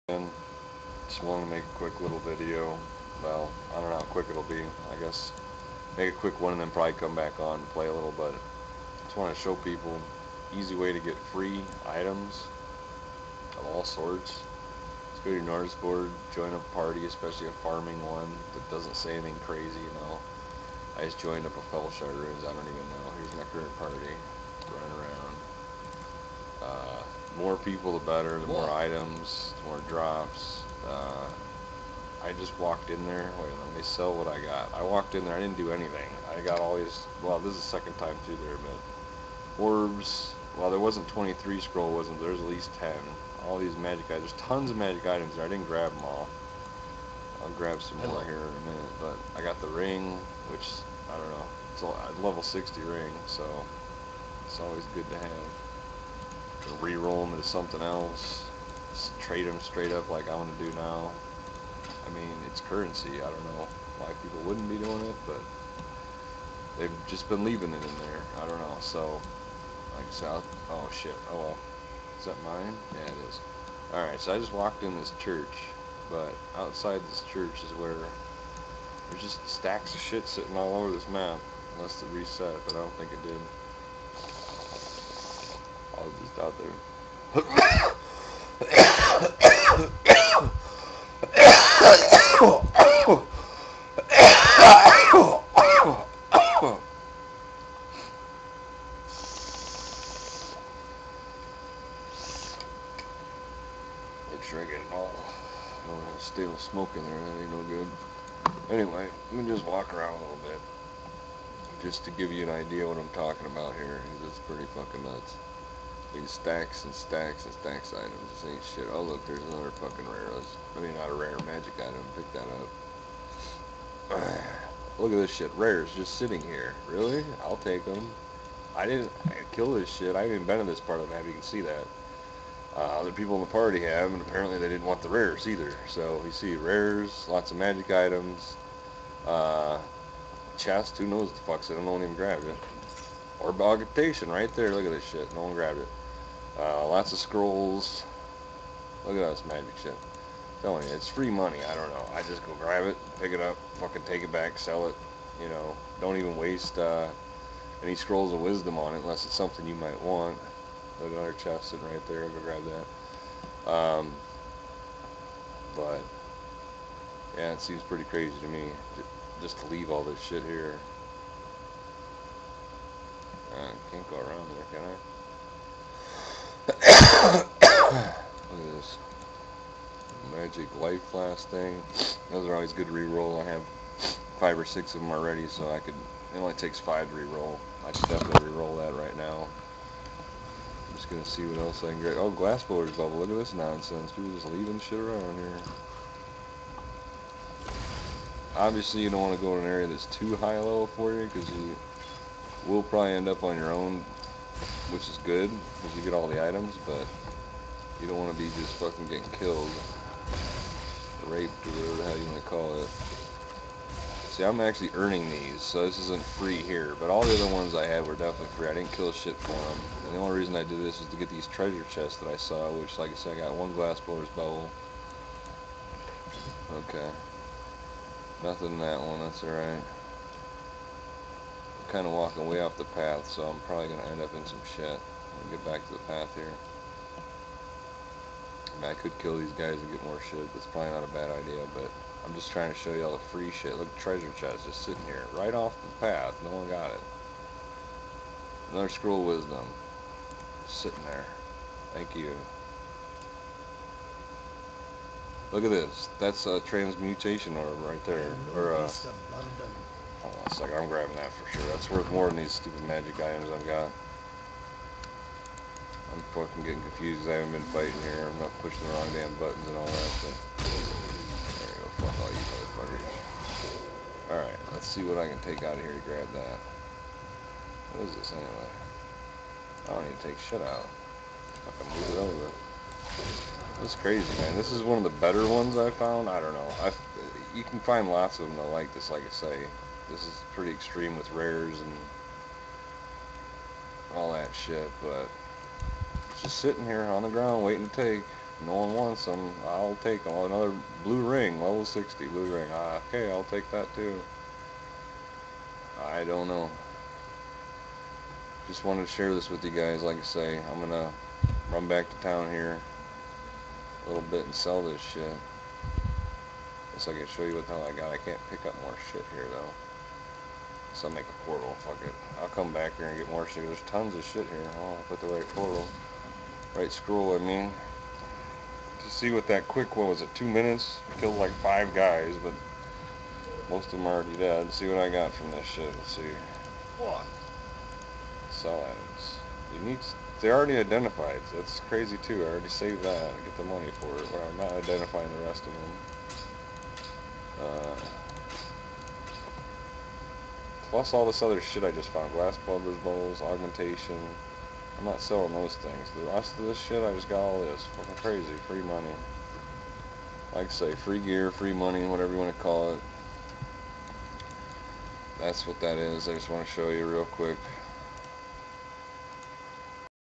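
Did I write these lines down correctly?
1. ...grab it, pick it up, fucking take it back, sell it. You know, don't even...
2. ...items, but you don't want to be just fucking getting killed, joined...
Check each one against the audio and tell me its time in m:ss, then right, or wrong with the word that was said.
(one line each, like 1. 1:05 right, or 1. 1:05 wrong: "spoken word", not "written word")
1. 2:32 right
2. 3:26 wrong: "raped", not "joined".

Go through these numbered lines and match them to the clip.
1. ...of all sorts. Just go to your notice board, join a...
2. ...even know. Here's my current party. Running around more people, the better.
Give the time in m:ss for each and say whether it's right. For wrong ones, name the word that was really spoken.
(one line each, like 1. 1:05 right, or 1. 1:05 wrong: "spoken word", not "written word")
1. 0:13 right
2. 0:22 right.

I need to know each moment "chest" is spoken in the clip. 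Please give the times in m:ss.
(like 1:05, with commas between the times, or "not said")
2:20, 2:41, 3:41, 4:04.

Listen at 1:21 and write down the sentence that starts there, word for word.
Unless it reset, but I don't think it did.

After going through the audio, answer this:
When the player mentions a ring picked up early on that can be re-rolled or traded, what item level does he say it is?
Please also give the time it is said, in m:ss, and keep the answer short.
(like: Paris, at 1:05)
60, at 0:52.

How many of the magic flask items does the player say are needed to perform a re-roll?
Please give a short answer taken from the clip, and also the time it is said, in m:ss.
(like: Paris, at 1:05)
5, at 3:06.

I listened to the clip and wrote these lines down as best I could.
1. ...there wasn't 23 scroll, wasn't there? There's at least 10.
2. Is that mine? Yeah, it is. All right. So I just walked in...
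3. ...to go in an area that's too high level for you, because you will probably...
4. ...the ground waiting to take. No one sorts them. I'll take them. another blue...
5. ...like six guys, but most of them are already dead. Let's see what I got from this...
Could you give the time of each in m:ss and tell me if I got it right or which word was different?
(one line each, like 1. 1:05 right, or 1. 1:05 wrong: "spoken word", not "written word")
1. 0:40 right
2. 1:12 right
3. 3:19 right
4. 4:57 wrong: "wants", not "sorts"
5. 5:31 wrong: "five", not "six".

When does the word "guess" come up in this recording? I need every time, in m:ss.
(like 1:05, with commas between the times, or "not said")
0:04, 5:16.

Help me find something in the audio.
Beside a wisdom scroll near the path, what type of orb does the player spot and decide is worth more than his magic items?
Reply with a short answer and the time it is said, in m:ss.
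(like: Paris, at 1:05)
transmutation orb, at 4:16.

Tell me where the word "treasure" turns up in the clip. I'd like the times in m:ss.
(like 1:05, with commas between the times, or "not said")
3:41, 4:03.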